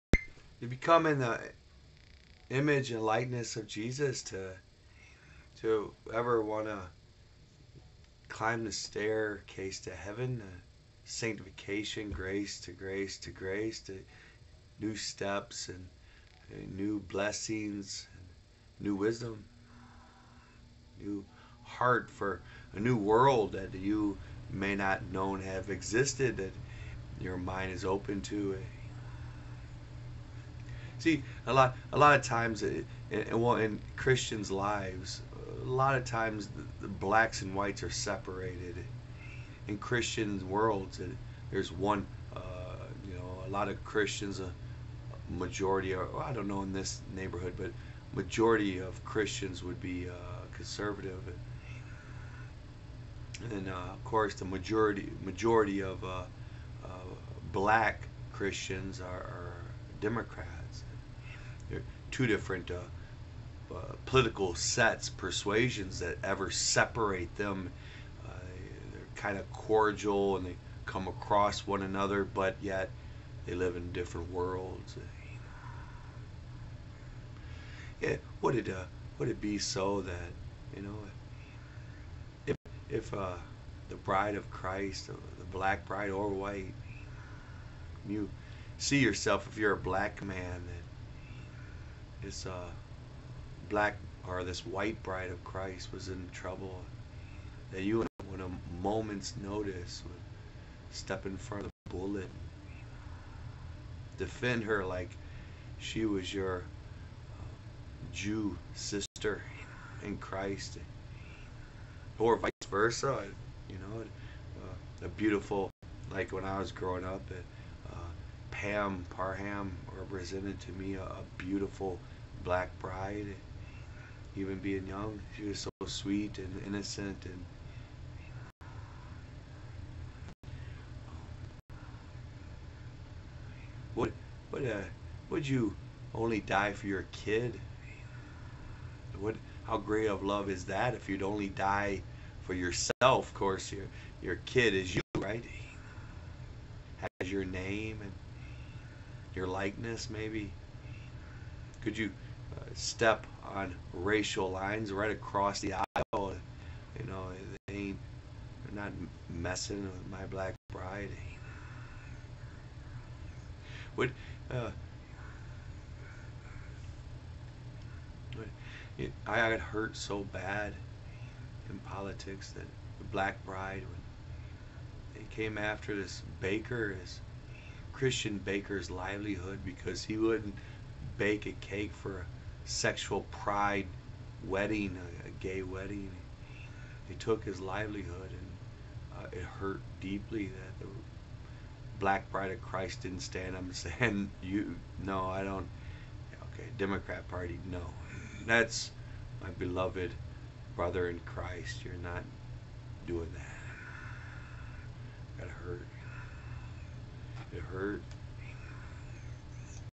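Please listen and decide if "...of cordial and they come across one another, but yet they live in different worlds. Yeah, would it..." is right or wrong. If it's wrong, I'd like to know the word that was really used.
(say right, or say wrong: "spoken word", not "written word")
right.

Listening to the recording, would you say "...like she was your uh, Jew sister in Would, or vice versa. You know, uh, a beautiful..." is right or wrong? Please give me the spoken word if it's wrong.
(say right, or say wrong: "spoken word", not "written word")
wrong: "Christ", not "Would".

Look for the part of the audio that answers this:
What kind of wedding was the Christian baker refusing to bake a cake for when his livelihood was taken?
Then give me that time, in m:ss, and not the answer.
3:05.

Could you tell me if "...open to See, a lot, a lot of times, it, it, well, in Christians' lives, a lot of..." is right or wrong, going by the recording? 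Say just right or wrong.
right.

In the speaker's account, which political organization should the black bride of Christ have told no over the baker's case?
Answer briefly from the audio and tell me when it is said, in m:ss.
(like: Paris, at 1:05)
Democrat Party, at 3:16.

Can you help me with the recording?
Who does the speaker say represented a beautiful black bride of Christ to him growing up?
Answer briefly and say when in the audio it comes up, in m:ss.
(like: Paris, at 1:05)
Pam Parham, at 1:58.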